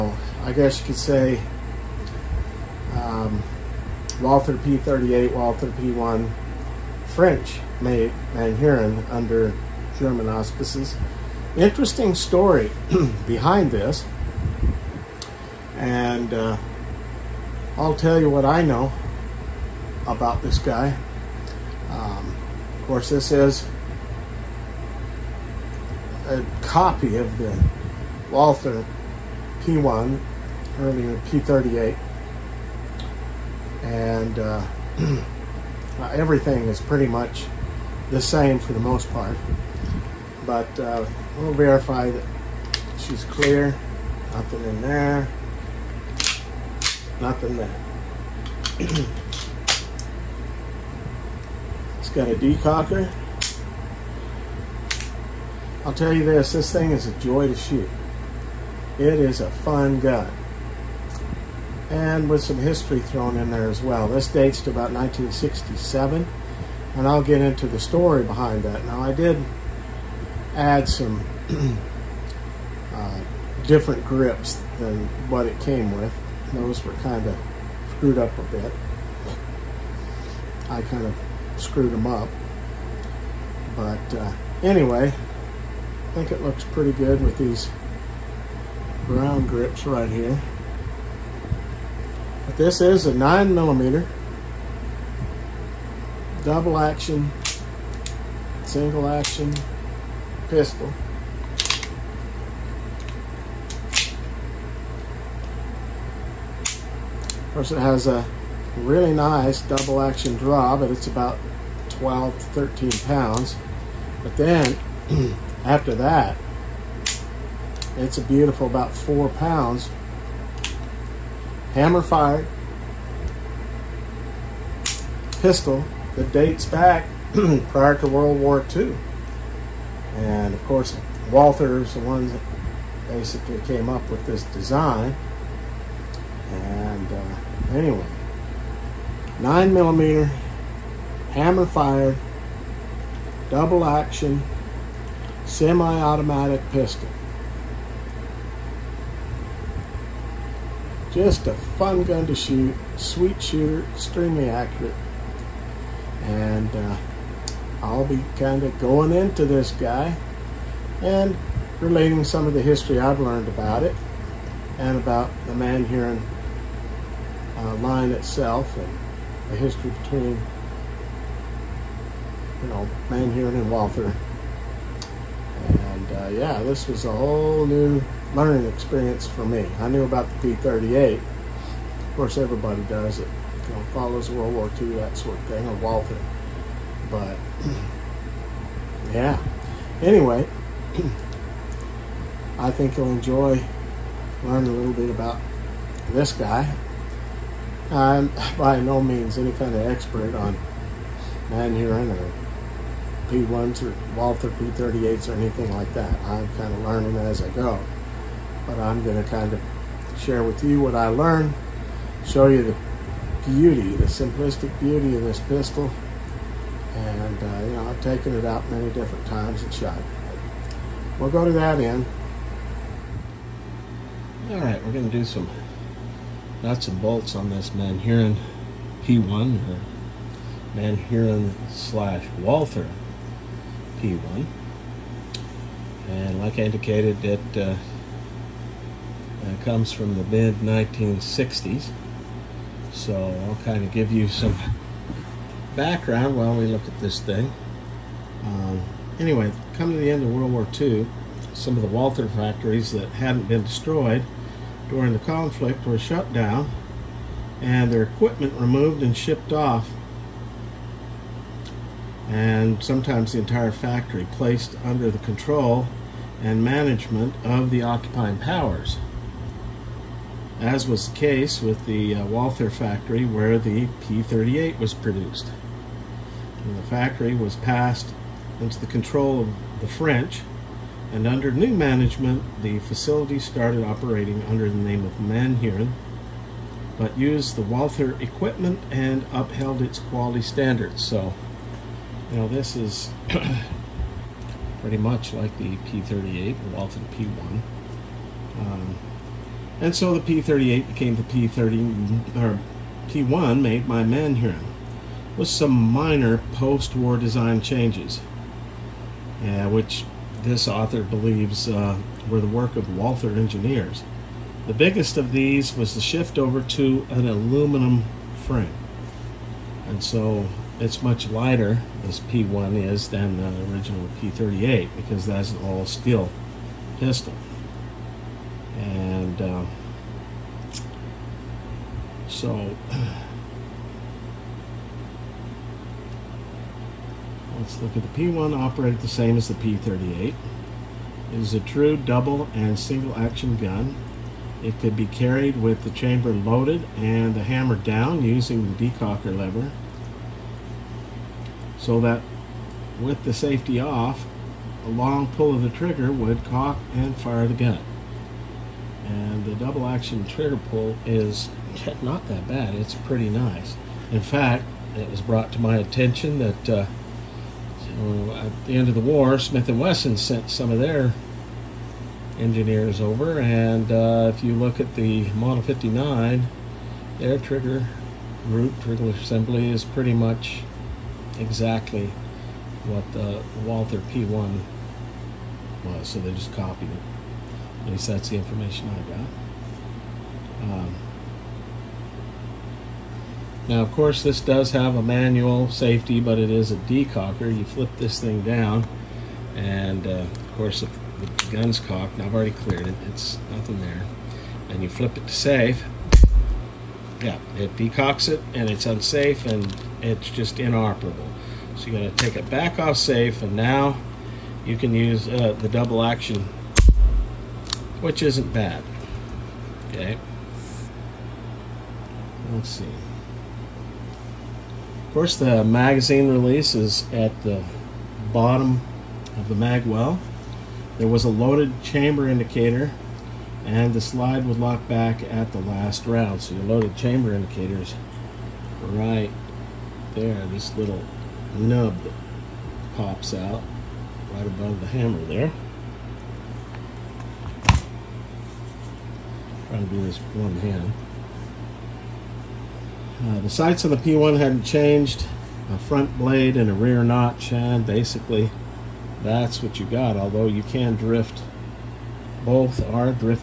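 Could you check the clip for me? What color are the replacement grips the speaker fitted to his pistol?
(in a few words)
Brown.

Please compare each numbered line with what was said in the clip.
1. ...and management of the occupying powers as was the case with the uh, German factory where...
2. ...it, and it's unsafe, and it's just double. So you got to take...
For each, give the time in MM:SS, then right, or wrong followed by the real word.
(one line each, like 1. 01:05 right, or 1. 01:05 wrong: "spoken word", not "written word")
1. 04:26 wrong: "Walther", not "German"
2. 06:48 wrong: "inoperable", not "double".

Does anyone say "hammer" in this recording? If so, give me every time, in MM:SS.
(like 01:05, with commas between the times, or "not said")
02:01, 02:21, 05:47, 07:24.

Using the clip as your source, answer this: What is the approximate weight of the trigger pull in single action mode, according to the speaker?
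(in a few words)
4 pounds.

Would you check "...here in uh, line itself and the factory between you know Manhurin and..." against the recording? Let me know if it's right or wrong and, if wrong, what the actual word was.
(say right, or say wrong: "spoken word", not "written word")
wrong: "history", not "factory".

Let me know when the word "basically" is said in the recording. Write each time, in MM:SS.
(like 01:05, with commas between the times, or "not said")
02:13, 07:37.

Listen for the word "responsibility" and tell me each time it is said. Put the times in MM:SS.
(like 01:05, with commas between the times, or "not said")
not said.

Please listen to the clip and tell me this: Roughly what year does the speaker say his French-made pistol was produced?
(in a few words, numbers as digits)
1967.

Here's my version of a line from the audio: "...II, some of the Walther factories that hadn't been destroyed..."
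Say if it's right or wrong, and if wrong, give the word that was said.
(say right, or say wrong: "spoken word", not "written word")
right.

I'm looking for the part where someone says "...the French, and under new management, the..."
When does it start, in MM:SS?
04:39.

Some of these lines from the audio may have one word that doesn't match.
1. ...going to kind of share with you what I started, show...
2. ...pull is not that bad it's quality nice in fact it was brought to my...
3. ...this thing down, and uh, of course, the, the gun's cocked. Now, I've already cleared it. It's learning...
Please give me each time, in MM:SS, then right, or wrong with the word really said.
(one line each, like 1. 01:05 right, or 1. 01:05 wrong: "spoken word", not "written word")
1. 03:29 wrong: "learned", not "started"
2. 06:00 wrong: "pretty", not "quality"
3. 06:37 wrong: "nothing", not "learning".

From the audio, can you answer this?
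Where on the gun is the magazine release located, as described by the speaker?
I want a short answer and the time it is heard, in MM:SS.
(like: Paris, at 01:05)
Bottom of the mag well, at 07:08.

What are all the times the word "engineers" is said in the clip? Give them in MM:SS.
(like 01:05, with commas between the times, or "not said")
05:13, 06:12.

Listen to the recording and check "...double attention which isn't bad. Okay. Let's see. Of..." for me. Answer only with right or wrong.
wrong.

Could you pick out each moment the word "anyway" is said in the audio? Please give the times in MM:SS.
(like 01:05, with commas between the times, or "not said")
01:24, 02:17, 03:10, 04:09.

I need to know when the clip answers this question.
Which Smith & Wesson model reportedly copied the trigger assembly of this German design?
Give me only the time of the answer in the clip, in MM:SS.
06:15.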